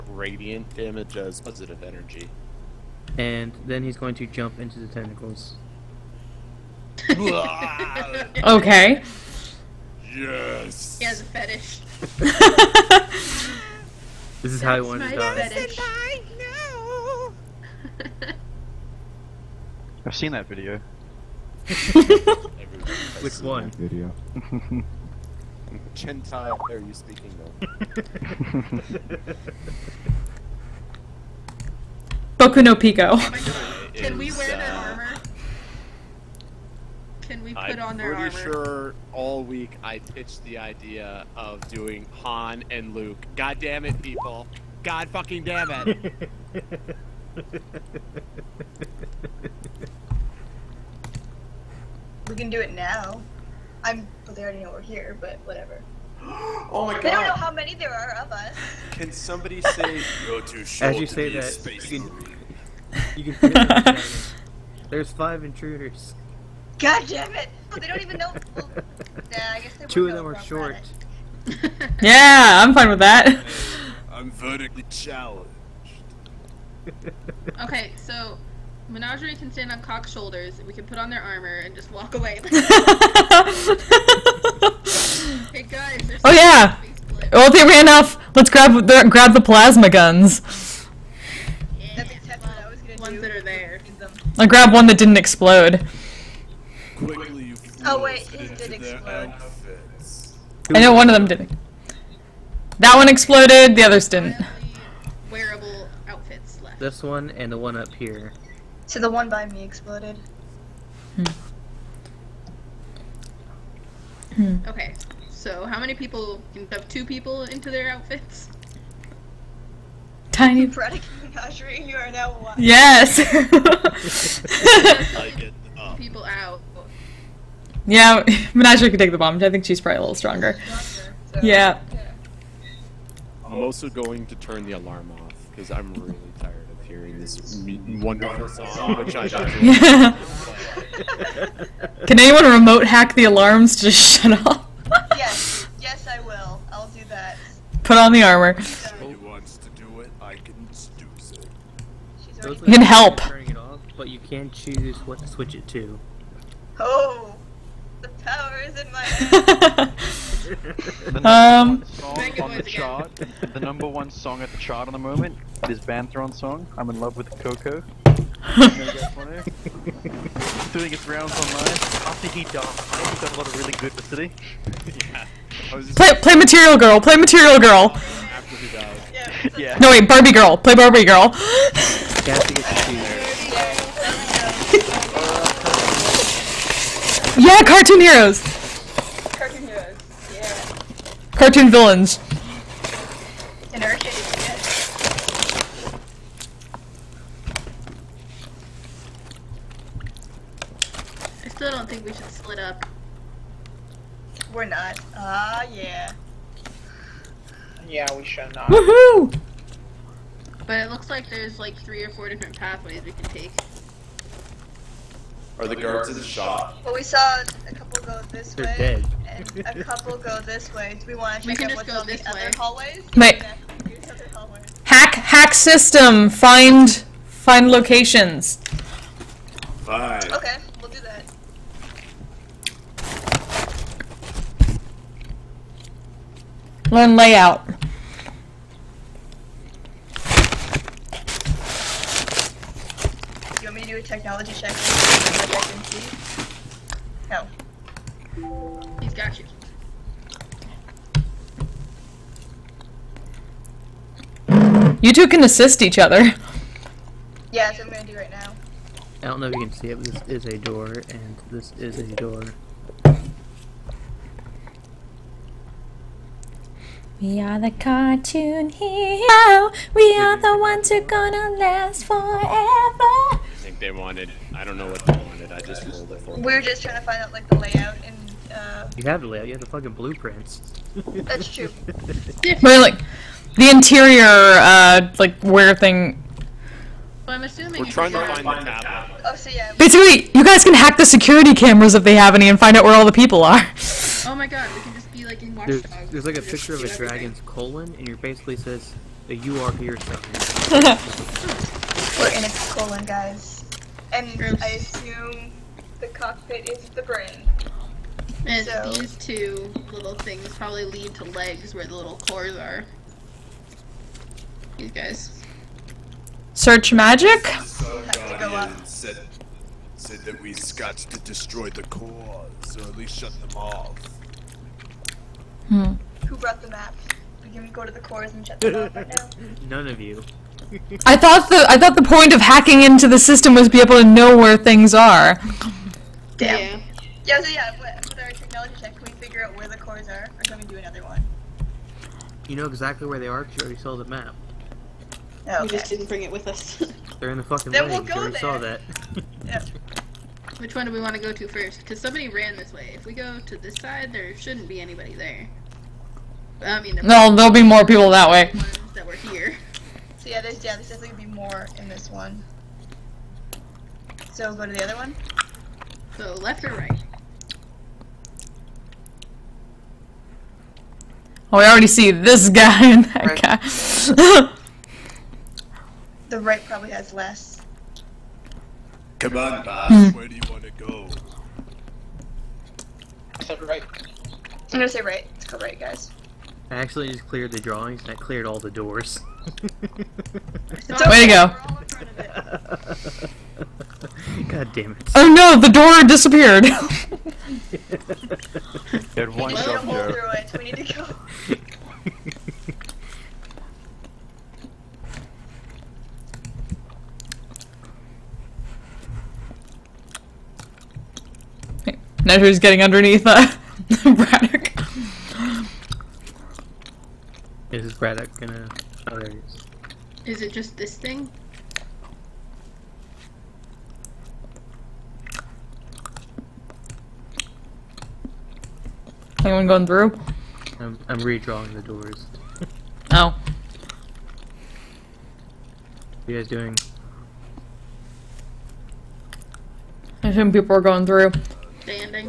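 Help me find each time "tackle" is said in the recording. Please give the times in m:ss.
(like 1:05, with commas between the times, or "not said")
not said.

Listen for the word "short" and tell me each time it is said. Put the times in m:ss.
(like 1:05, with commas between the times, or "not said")
1:00, 1:10.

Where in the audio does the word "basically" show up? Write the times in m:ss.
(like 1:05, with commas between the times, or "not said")
4:49, 4:58.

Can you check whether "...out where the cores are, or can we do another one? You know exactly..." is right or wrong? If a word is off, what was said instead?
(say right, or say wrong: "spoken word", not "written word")
right.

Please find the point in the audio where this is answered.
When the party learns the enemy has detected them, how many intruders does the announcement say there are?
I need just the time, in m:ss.
1:05.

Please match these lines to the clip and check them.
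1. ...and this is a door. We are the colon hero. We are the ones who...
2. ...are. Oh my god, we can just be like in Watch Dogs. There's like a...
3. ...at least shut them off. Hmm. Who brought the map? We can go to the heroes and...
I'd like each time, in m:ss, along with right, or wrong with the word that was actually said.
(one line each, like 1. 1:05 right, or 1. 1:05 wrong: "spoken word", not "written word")
1. 4:21 wrong: "cartoon", not "colon"
2. 4:53 right
3. 5:22 wrong: "cores", not "heroes".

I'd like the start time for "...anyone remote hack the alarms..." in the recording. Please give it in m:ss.
2:22.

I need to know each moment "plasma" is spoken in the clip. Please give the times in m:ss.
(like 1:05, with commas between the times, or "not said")
1:29.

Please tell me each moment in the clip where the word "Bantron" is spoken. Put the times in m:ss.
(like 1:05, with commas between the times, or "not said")
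2:45.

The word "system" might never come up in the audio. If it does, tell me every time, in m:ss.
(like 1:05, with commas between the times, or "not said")
3:45, 5:33.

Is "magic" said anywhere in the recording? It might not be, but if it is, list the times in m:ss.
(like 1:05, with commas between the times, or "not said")
5:16.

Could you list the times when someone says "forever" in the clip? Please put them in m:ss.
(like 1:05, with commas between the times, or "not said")
4:32.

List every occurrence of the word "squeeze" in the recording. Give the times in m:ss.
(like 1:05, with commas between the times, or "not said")
not said.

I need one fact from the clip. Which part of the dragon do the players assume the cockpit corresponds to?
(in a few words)
The brain.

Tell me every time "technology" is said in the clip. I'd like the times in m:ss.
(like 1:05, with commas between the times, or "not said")
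4:04, 5:38.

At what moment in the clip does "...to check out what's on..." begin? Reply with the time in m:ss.
3:41.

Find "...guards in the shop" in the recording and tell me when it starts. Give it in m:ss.
3:35.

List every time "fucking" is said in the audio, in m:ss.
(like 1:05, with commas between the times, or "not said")
0:45, 4:39, 5:47.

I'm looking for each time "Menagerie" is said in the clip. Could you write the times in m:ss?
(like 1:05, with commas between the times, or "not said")
1:18, 2:08.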